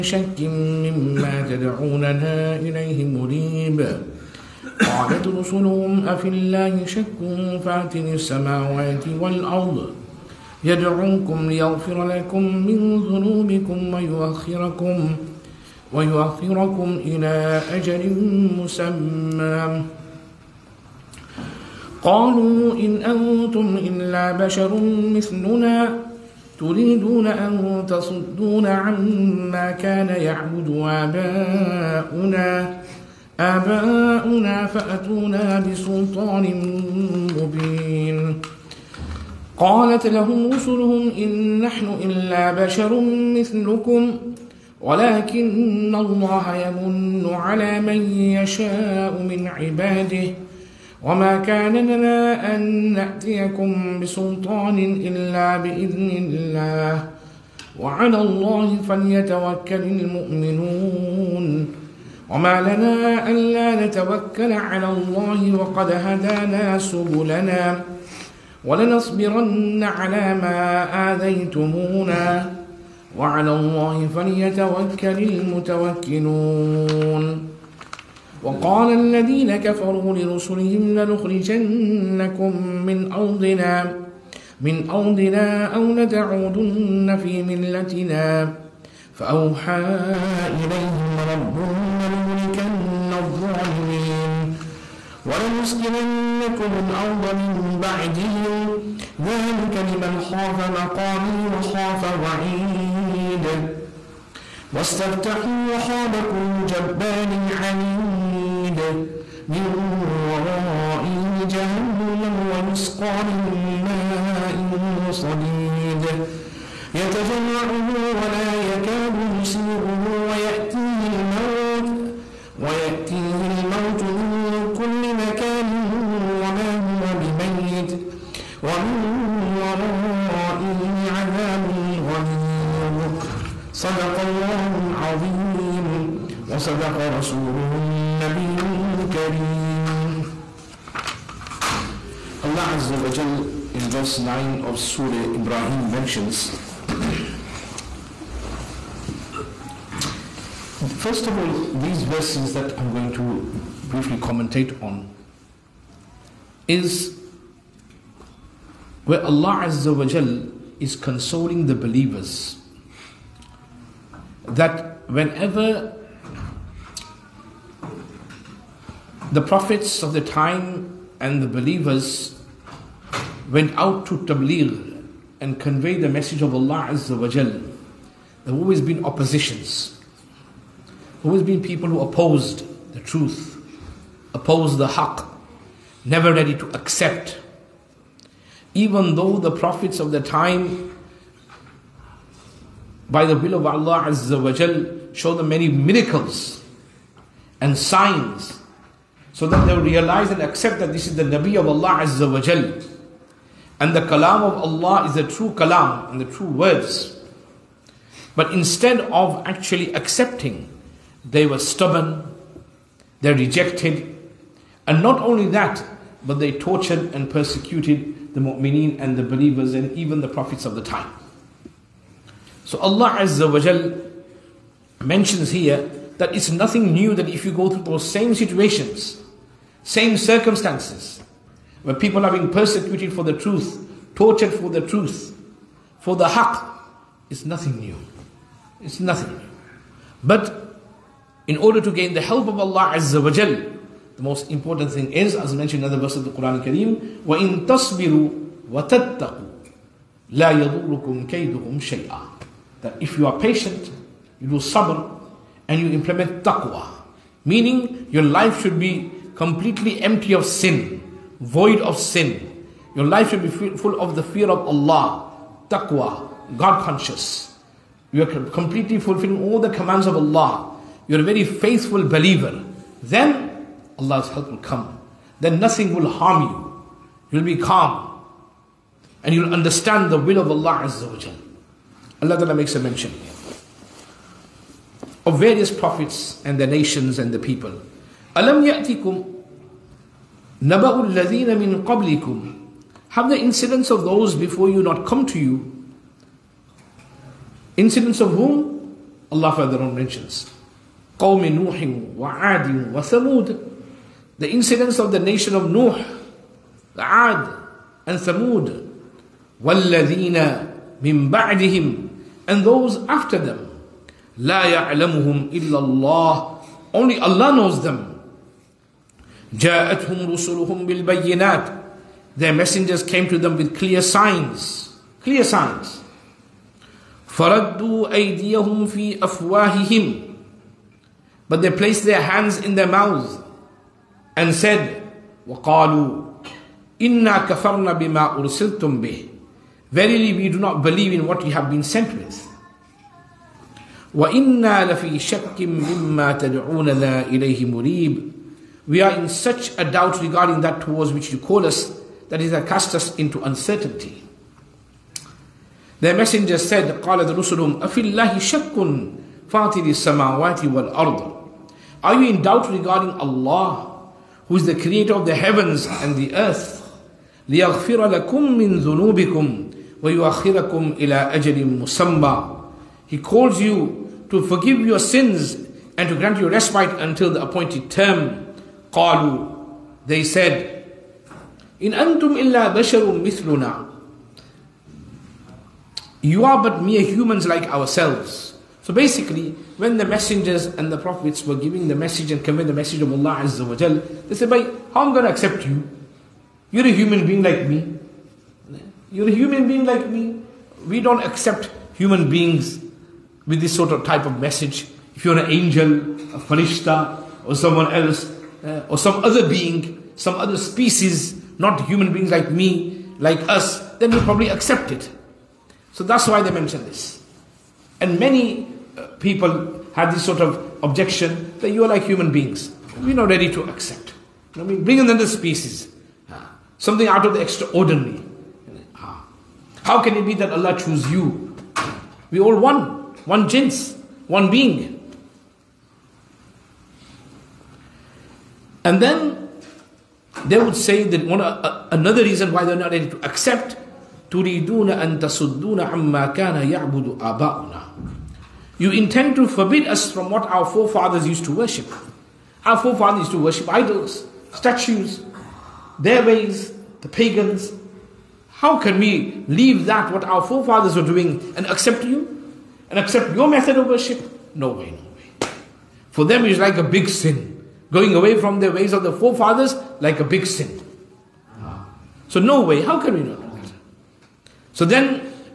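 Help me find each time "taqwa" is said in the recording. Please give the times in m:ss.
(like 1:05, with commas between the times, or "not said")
4:16, 4:25.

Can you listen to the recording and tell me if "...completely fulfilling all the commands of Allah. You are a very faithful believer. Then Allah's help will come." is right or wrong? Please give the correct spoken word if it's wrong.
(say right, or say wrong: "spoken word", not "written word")
right.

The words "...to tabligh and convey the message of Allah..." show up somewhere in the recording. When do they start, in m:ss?
2:54.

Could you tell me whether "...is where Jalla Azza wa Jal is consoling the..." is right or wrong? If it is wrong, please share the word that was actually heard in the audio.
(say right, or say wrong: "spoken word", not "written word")
wrong: "Allah", not "Jalla".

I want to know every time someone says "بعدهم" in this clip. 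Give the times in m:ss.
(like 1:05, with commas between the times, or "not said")
1:37, 5:11.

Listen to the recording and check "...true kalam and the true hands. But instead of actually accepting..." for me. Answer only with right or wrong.
wrong.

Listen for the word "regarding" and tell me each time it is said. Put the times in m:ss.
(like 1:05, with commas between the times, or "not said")
5:50, 6:02.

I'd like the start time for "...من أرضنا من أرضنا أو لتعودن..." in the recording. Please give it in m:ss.
1:22.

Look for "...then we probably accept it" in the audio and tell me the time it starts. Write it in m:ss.
6:53.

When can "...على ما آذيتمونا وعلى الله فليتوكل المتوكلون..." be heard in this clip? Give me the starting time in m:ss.
1:09.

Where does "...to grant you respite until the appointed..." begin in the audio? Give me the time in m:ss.
6:16.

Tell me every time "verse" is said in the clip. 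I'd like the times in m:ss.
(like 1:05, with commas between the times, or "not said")
2:23, 2:32, 4:06.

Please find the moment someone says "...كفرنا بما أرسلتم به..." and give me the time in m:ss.
5:37.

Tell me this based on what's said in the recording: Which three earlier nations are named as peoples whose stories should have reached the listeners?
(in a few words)
Nuh, Ad and Thamud.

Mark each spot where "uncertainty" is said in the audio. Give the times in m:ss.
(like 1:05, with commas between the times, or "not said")
5:53.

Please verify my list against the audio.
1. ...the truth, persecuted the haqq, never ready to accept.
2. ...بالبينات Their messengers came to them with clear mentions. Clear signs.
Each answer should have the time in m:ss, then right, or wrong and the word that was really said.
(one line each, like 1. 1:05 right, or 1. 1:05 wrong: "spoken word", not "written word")
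1. 3:02 wrong: "opposed", not "persecuted"
2. 5:20 wrong: "signs", not "mentions".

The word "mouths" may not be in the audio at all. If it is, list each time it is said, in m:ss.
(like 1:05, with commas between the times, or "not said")
5:32.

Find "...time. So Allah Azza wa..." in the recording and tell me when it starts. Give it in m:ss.
3:40.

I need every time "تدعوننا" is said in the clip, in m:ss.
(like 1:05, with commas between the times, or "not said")
0:01, 5:46.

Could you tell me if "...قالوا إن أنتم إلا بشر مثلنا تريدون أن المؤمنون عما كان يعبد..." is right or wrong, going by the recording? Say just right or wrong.
wrong.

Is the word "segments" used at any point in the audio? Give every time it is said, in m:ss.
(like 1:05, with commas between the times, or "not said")
not said.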